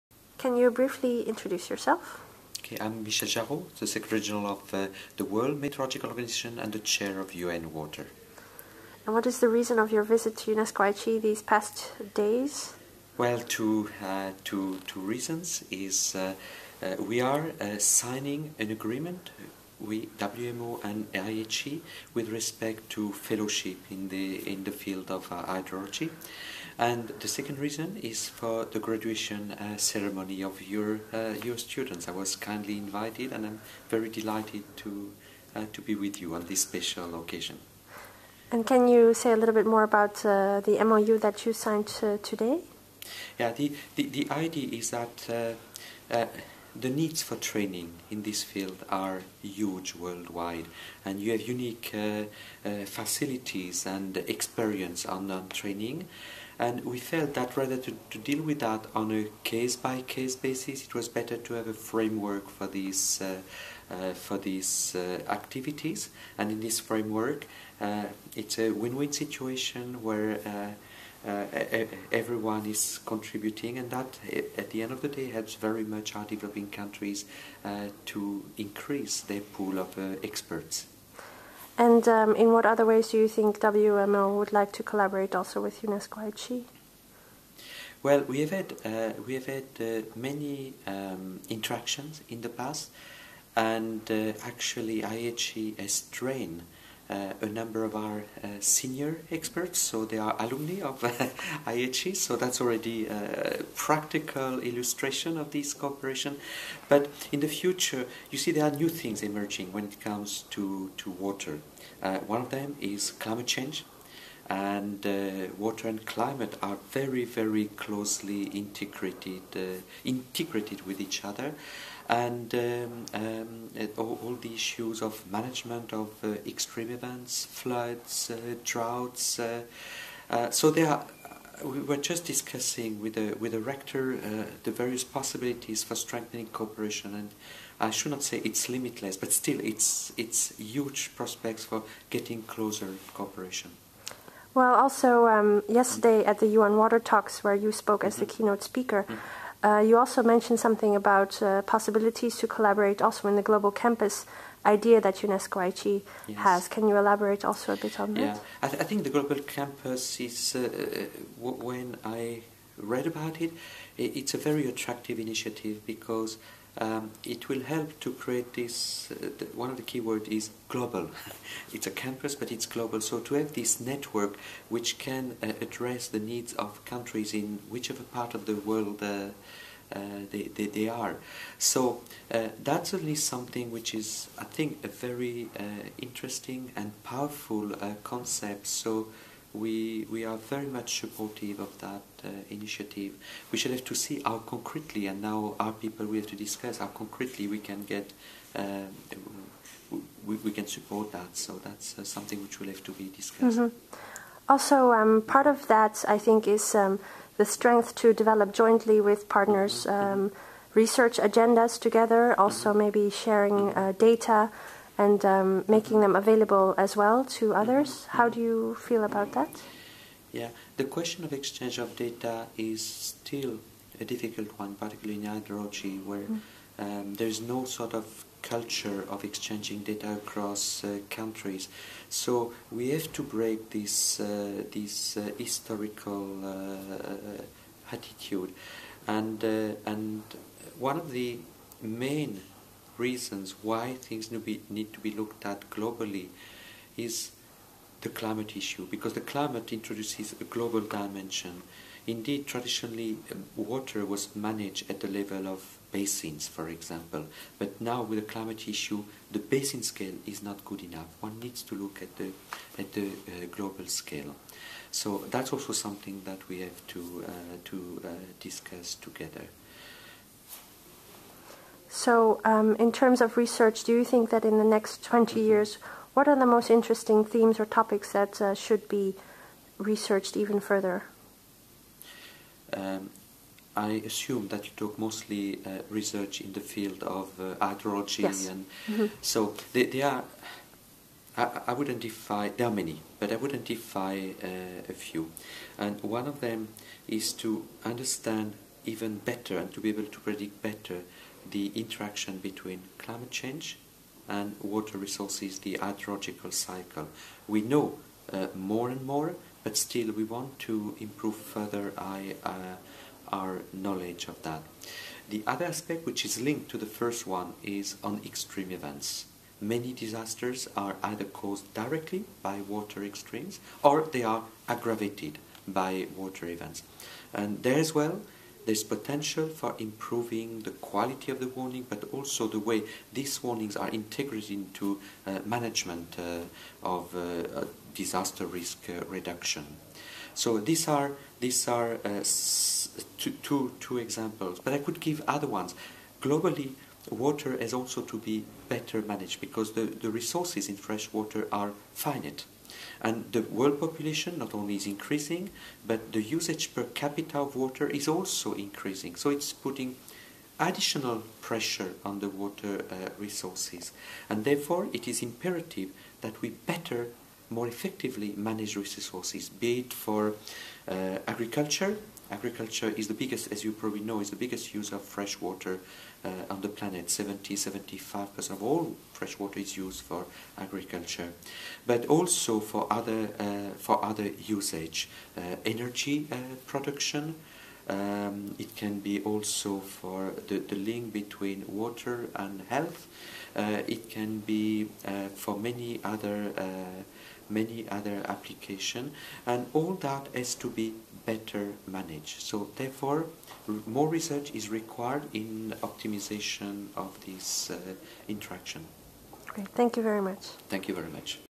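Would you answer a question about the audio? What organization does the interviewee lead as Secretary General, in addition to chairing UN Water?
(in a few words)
World Meteorological Organization.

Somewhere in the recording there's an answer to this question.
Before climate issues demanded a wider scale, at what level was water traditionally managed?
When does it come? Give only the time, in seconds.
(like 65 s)
255 s.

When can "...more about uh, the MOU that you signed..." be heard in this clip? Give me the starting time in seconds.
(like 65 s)
39 s.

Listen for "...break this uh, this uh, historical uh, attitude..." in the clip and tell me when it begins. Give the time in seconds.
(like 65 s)
233 s.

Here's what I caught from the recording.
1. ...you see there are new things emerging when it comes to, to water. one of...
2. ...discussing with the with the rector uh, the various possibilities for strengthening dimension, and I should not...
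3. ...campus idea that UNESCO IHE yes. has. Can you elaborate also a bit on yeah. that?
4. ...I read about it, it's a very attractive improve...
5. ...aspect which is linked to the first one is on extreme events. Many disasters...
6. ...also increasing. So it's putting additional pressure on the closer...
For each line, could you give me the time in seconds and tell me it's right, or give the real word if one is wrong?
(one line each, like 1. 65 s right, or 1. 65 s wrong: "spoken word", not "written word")
1. 108 s right
2. 132 s wrong: "cooperation", not "dimension"
3. 153 s right
4. 162 s wrong: "initiative", not "improve"
5. 315 s right
6. 358 s wrong: "water", not "closer".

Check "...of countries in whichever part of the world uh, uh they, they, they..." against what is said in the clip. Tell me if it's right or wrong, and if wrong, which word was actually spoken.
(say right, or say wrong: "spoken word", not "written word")
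right.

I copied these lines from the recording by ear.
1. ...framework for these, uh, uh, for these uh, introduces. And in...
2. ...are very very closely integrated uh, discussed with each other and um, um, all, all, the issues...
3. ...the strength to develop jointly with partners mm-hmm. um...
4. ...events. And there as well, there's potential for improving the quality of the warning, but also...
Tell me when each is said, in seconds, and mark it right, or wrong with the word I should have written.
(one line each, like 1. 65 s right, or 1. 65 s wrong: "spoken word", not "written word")
1. 61 s wrong: "activities", not "introduces"
2. 116 s wrong: "integrated", not "discussed"
3. 207 s right
4. 326 s right.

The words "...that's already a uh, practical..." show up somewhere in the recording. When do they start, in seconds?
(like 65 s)
102 s.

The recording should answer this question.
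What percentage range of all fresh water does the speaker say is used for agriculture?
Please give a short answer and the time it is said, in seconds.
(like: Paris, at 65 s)
70-75%, at 377 s.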